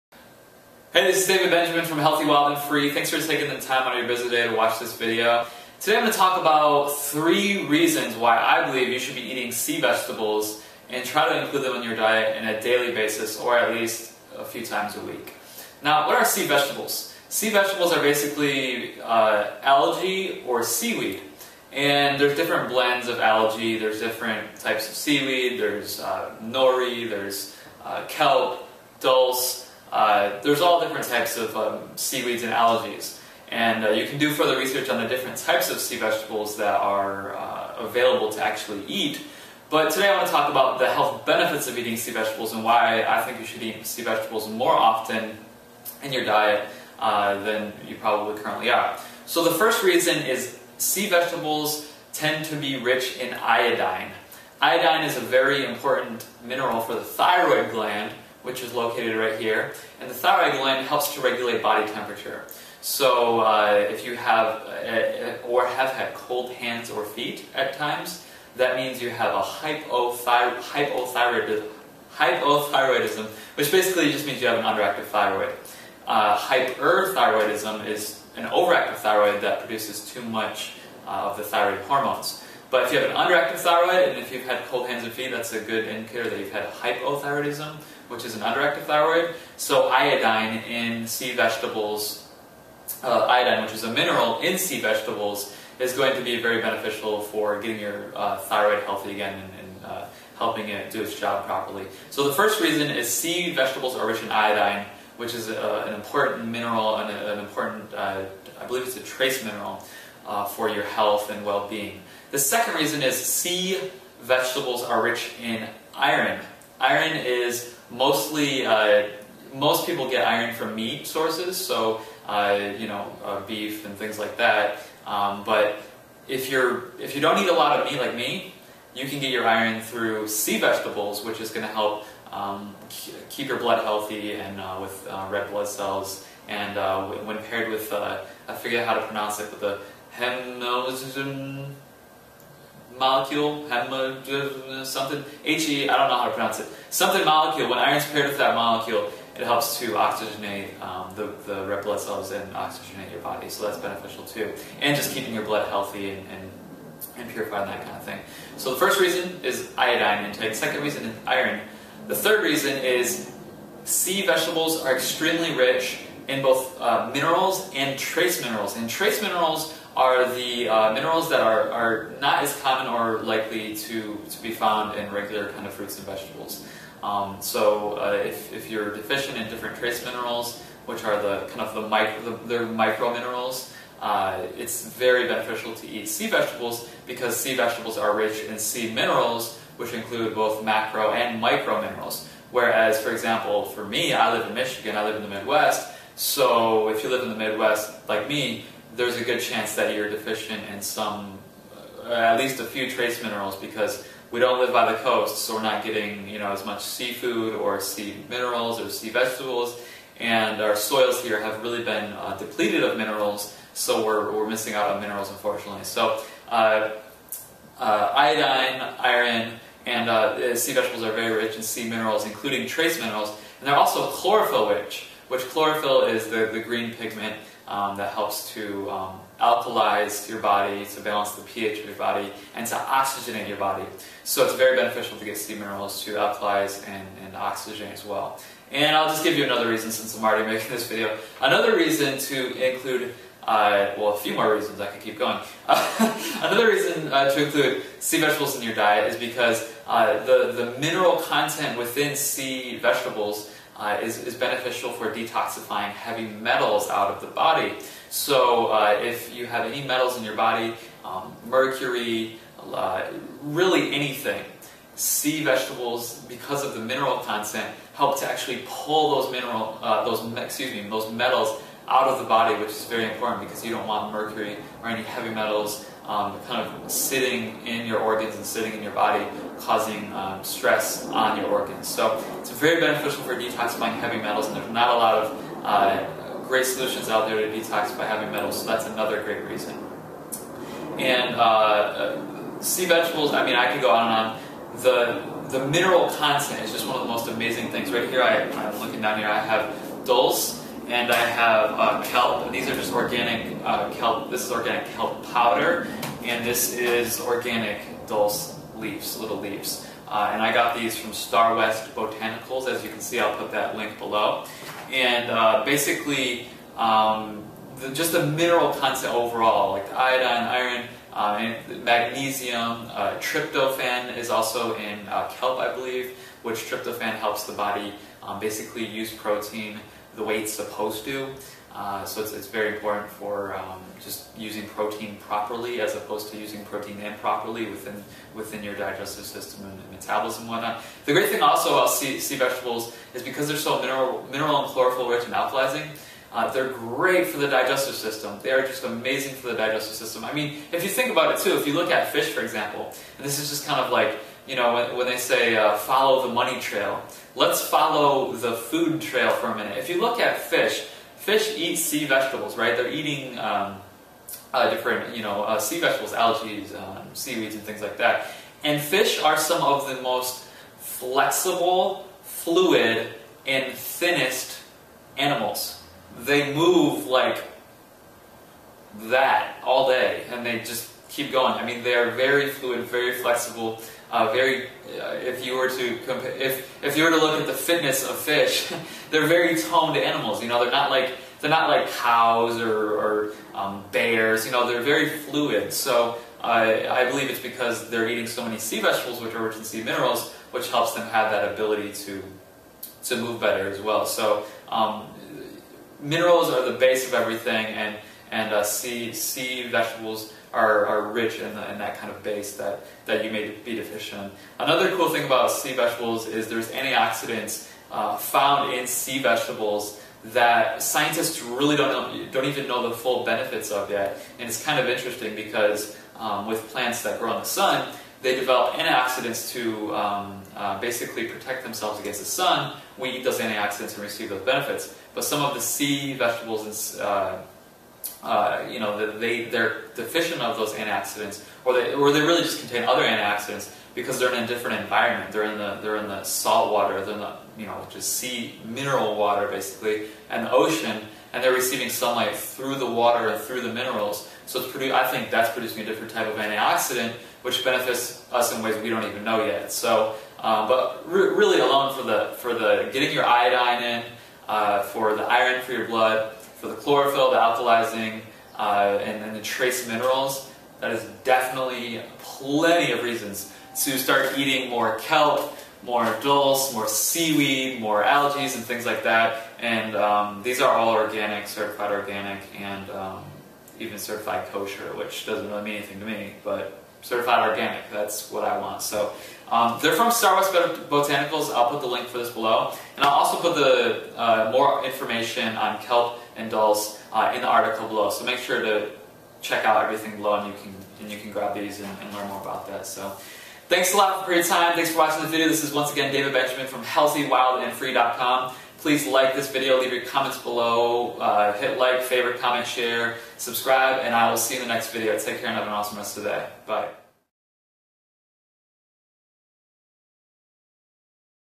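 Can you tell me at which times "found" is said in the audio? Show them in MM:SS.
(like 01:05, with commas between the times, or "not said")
02:54, 06:58.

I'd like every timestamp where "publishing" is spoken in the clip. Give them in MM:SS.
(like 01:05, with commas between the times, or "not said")
not said.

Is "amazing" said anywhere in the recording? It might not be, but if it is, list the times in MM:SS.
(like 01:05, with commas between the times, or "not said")
04:57, 05:48.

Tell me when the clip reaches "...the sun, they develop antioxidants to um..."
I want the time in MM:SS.
07:07.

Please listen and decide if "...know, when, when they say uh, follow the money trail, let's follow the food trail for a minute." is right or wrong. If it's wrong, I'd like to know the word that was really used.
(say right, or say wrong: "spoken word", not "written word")
right.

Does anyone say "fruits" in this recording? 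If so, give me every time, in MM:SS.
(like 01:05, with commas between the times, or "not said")
02:55.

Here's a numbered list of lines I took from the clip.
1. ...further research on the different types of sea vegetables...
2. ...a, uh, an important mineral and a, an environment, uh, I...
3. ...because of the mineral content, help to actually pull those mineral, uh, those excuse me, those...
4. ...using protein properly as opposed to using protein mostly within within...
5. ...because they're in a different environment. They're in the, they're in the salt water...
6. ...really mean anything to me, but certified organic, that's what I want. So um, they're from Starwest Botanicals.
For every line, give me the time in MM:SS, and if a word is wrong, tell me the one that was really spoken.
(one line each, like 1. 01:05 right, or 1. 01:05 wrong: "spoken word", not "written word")
1. 00:34 right
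2. 01:45 wrong: "important", not "environment"
3. 04:26 right
4. 05:34 wrong: "improperly", not "mostly"
5. 07:23 right
6. 08:05 right.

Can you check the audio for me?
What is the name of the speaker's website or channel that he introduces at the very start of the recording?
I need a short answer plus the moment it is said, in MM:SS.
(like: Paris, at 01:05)
Healthy, Wild, and Free, at 00:01.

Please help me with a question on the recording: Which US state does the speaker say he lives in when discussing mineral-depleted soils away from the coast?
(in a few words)
Michigan.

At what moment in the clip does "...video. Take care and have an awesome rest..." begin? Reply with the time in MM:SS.
08:34.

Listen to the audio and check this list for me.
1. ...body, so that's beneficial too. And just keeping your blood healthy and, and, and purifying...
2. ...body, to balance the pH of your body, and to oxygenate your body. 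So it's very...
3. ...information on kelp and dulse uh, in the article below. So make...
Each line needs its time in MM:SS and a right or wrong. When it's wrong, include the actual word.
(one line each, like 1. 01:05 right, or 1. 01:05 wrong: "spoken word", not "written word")
1. 02:33 right
2. 03:50 right
3. 08:14 right.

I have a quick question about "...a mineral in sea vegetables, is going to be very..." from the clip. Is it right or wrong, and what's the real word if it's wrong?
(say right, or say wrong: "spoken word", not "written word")
right.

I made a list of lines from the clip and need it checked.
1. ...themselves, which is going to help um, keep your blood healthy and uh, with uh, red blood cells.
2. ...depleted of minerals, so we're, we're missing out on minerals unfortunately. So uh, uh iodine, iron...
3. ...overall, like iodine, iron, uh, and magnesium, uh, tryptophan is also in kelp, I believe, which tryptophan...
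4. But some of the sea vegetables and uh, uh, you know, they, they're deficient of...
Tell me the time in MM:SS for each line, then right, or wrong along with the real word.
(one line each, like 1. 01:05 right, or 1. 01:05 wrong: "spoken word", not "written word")
1. 02:10 wrong: "vegetables", not "themselves"
2. 03:32 right
3. 05:19 right
4. 07:15 right.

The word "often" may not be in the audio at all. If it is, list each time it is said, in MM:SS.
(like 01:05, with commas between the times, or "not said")
00:44.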